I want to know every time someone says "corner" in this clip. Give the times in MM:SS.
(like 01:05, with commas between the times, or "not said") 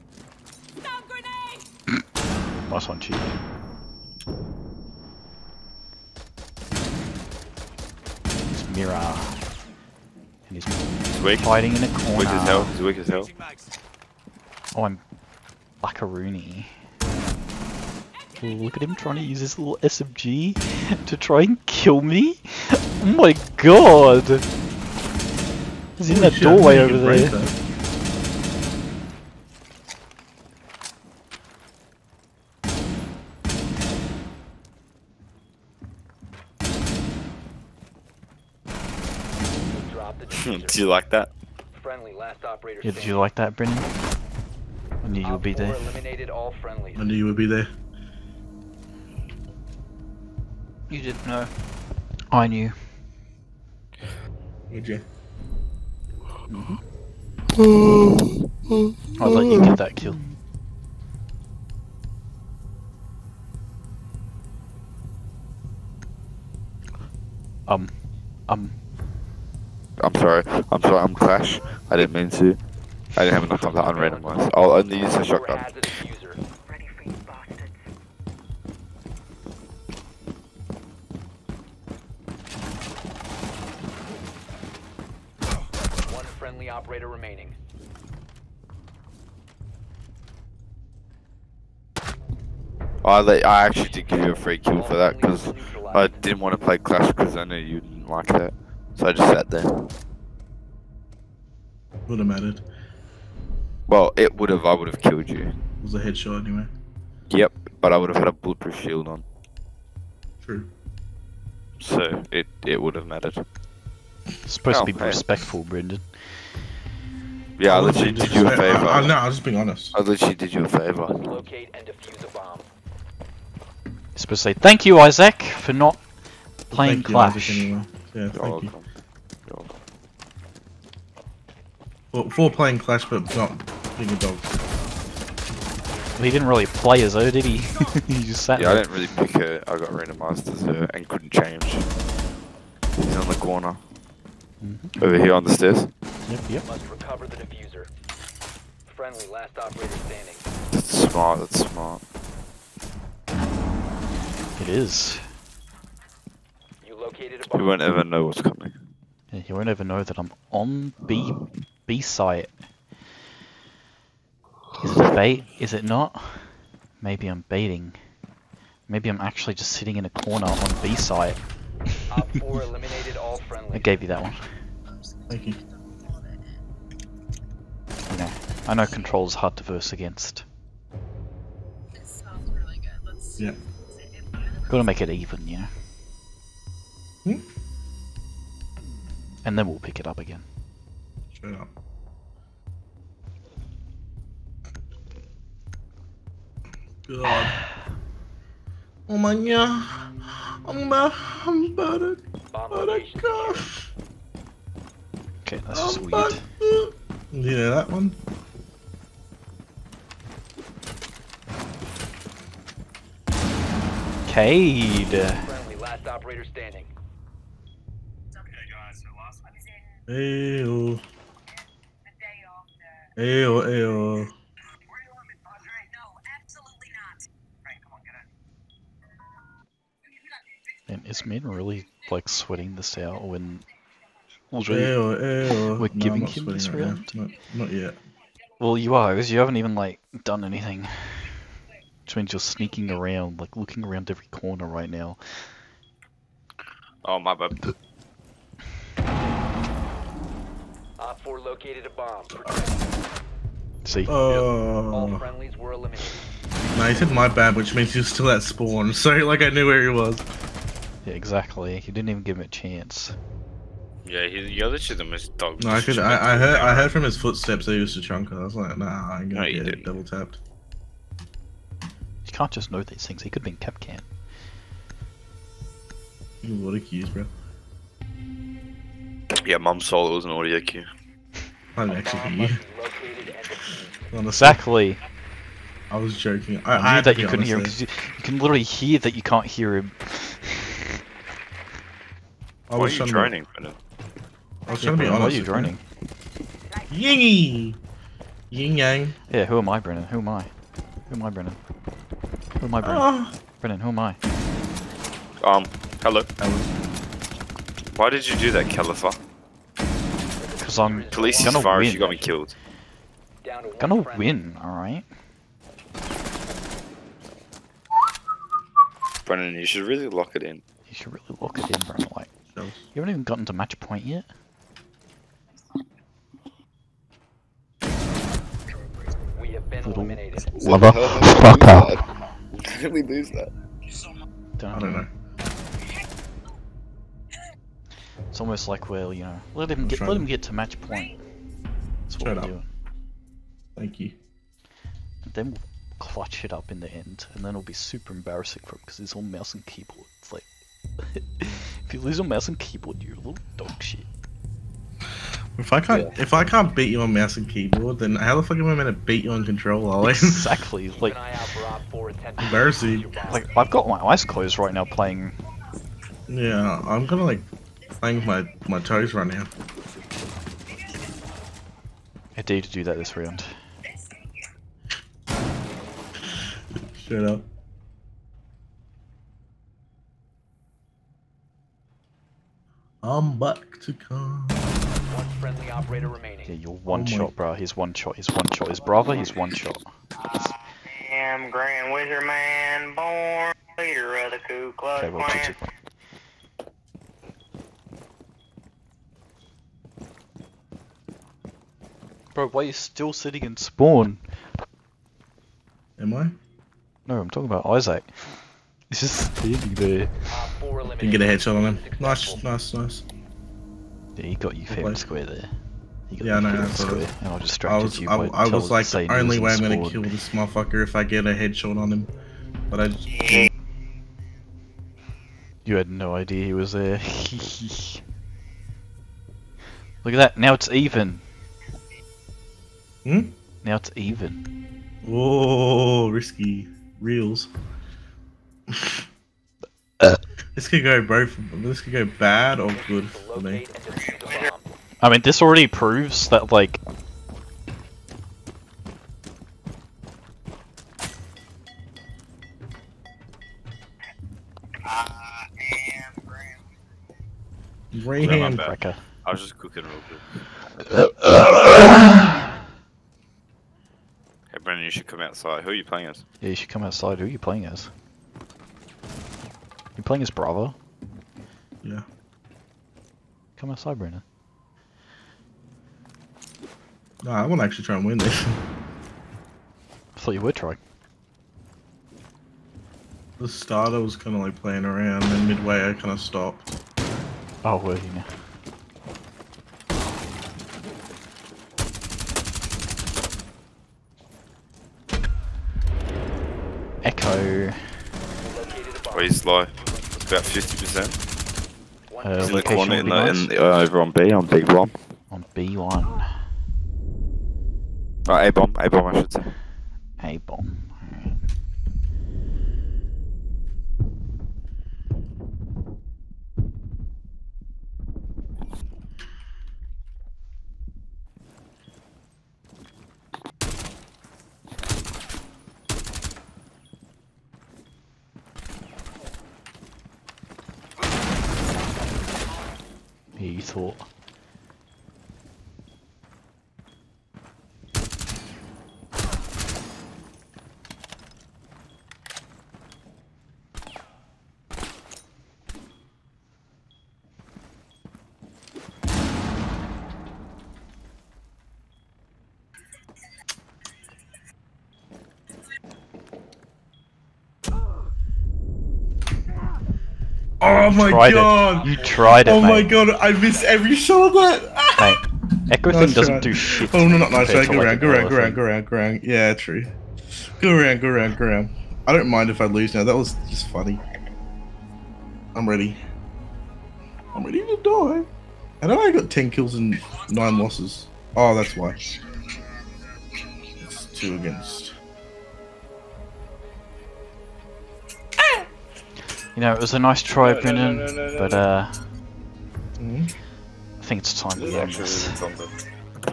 00:11, 02:23, 02:50, 04:04, 08:22.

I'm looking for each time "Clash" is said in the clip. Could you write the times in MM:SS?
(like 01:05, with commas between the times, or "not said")
01:11, 01:36, 02:07, 02:12.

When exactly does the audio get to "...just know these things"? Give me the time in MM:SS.
04:32.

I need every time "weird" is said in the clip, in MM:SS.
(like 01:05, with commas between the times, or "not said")
03:26.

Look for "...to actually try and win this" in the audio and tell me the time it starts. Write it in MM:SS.
07:57.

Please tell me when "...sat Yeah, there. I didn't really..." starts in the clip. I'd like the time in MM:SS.
02:18.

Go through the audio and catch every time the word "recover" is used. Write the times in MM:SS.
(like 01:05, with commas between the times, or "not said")
02:26.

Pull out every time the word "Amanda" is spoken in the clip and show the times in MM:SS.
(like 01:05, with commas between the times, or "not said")
not said.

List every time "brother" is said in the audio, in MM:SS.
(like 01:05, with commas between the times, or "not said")
06:28.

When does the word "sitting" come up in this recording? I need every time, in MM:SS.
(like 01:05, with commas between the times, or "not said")
02:49, 06:43.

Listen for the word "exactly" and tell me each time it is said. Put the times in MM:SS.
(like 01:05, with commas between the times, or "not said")
04:21, 04:44, 06:00.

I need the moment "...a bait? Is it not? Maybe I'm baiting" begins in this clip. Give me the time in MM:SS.
02:45.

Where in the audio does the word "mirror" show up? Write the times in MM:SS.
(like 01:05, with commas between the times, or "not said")
00:08.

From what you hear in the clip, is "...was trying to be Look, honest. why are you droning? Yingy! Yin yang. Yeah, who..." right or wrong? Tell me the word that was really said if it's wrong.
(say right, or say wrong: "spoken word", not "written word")
wrong: "Brennan", not "Look".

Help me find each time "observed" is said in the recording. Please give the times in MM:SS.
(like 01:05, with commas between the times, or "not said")
not said.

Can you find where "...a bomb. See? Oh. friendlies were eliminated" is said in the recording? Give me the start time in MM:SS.
04:11.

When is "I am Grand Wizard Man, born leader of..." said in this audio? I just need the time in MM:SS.
06:30.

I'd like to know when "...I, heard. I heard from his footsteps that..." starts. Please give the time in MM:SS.
04:26.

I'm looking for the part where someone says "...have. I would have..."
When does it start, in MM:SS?
01:44.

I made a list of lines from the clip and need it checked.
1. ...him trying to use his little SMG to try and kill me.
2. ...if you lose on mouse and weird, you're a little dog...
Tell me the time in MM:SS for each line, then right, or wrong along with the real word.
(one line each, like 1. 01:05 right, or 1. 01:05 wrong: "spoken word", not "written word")
1. 00:18 right
2. 05:51 wrong: "keyboard", not "weird".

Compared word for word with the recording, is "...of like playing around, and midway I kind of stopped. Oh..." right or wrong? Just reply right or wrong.
right.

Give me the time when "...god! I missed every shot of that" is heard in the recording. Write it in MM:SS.
09:22.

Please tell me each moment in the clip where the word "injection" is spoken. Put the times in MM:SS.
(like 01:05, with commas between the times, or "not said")
not said.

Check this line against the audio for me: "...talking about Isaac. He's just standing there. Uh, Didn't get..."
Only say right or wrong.
right.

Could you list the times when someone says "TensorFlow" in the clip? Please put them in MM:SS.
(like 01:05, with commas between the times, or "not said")
not said.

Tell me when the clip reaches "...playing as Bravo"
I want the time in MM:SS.
07:50.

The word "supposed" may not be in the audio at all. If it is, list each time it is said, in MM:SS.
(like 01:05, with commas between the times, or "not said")
01:54, 02:04.